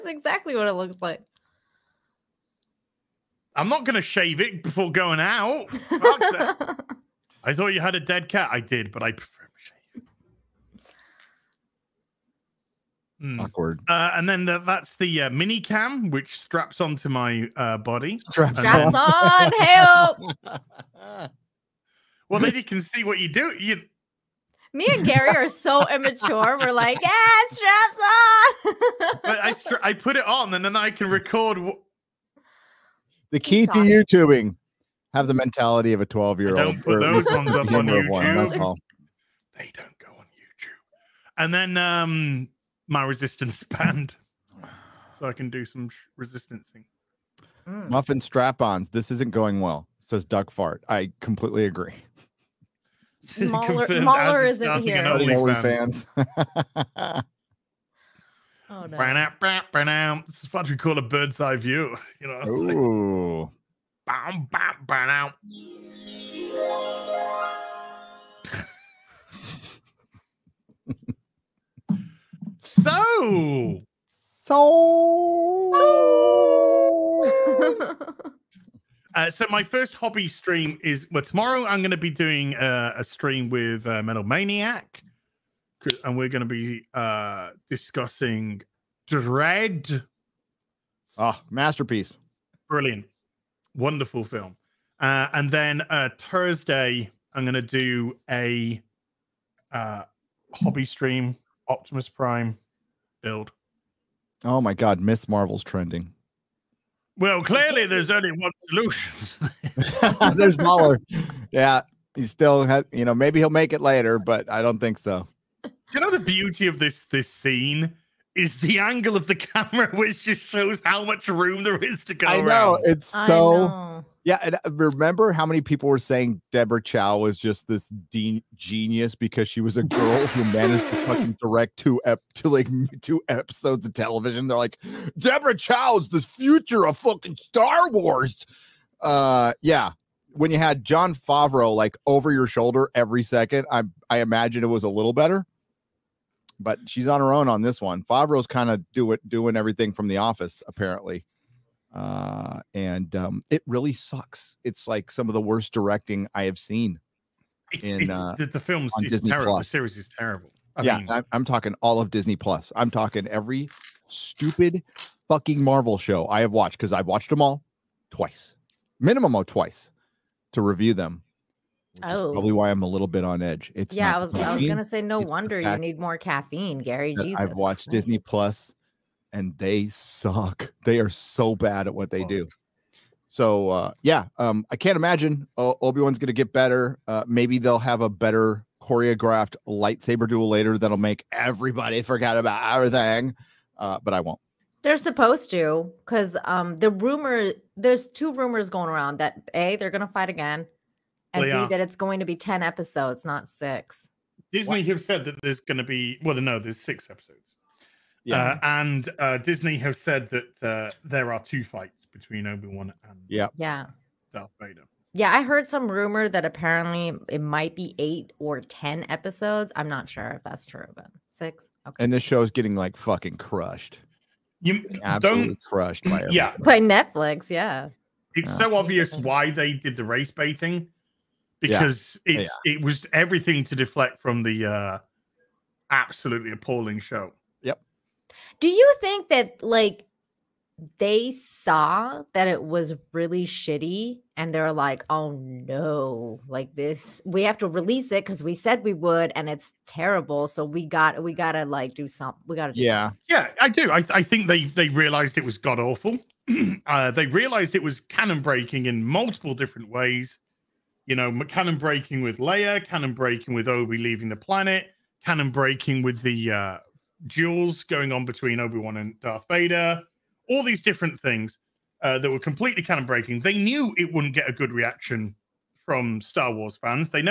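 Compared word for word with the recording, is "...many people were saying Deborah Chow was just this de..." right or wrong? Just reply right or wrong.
right.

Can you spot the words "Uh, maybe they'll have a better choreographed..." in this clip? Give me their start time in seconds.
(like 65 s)
187 s.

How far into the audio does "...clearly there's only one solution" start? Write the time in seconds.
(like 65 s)
107 s.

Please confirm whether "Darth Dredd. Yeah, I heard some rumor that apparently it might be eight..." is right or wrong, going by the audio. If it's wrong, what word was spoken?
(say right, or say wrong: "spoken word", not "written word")
wrong: "Vader", not "Dredd".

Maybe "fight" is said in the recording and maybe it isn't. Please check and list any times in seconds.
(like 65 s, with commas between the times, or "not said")
200 s, 211 s.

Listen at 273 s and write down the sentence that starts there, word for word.
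They knew it wouldn't get a good reaction from Star Wars fans.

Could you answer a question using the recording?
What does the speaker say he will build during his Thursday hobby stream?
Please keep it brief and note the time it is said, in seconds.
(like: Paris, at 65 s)
Optimus Prime, at 101 s.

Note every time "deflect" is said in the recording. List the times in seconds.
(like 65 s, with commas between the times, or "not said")
233 s.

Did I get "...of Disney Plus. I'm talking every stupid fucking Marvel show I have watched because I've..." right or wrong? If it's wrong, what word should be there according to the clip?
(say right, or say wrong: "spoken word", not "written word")
right.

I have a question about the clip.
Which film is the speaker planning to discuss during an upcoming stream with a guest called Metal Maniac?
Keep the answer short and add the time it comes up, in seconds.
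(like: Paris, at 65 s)
Dredd, at 89 s.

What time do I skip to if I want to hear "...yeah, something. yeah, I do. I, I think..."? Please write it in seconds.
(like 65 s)
252 s.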